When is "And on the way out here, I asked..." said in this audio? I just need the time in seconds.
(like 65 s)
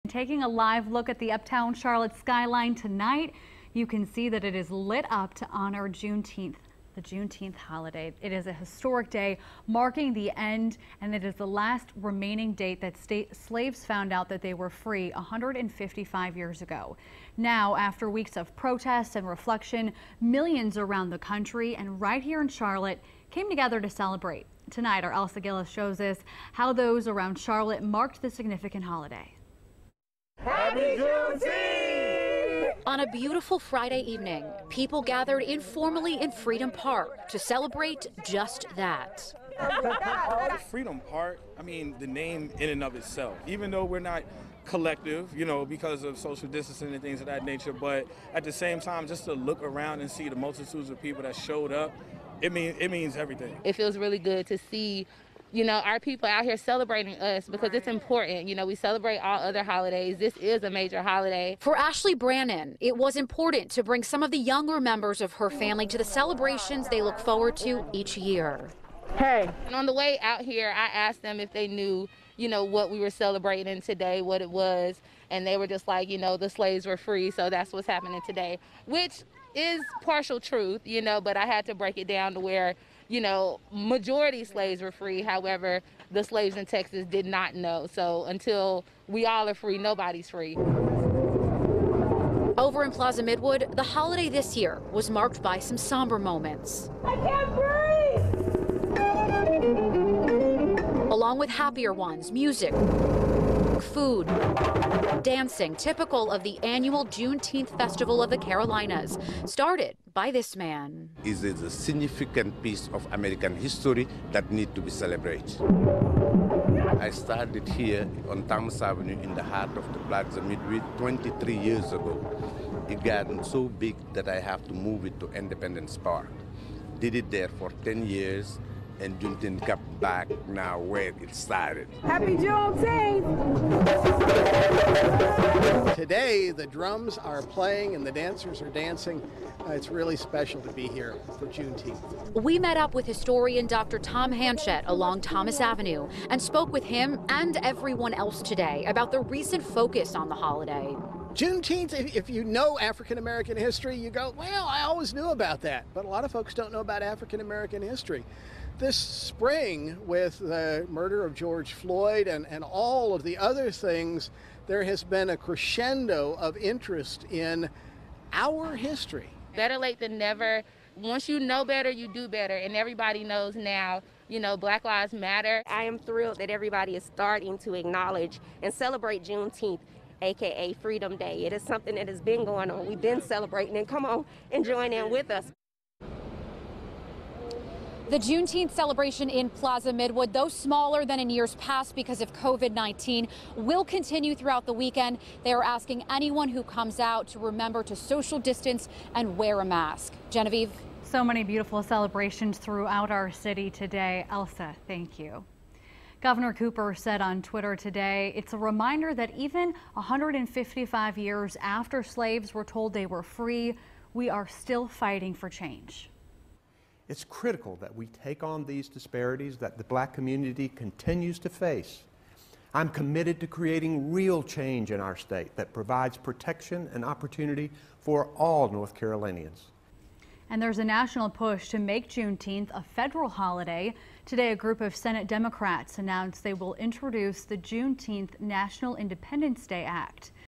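69 s.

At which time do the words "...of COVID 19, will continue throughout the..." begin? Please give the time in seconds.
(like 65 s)
192 s.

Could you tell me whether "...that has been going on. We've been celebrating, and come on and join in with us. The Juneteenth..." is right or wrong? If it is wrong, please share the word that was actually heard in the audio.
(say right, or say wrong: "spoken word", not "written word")
right.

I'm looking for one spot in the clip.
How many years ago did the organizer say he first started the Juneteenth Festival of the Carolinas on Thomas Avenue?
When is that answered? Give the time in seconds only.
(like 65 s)
120 s.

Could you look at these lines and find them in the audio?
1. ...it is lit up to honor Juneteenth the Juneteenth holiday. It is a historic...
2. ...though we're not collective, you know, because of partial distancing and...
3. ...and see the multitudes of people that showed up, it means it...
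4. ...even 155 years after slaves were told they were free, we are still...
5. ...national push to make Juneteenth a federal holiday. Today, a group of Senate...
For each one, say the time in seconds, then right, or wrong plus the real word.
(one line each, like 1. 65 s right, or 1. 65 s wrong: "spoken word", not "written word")
1. 4 s right
2. 43 s wrong: "social", not "partial"
3. 49 s right
4. 209 s right
5. 230 s right.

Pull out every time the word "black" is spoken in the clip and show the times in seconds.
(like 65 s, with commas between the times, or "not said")
174 s, 219 s.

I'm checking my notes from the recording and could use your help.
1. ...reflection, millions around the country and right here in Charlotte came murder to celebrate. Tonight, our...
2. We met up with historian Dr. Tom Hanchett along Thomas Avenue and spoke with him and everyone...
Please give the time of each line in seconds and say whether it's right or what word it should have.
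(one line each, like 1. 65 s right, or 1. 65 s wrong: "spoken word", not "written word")
1. 19 s wrong: "together", not "murder"
2. 142 s right.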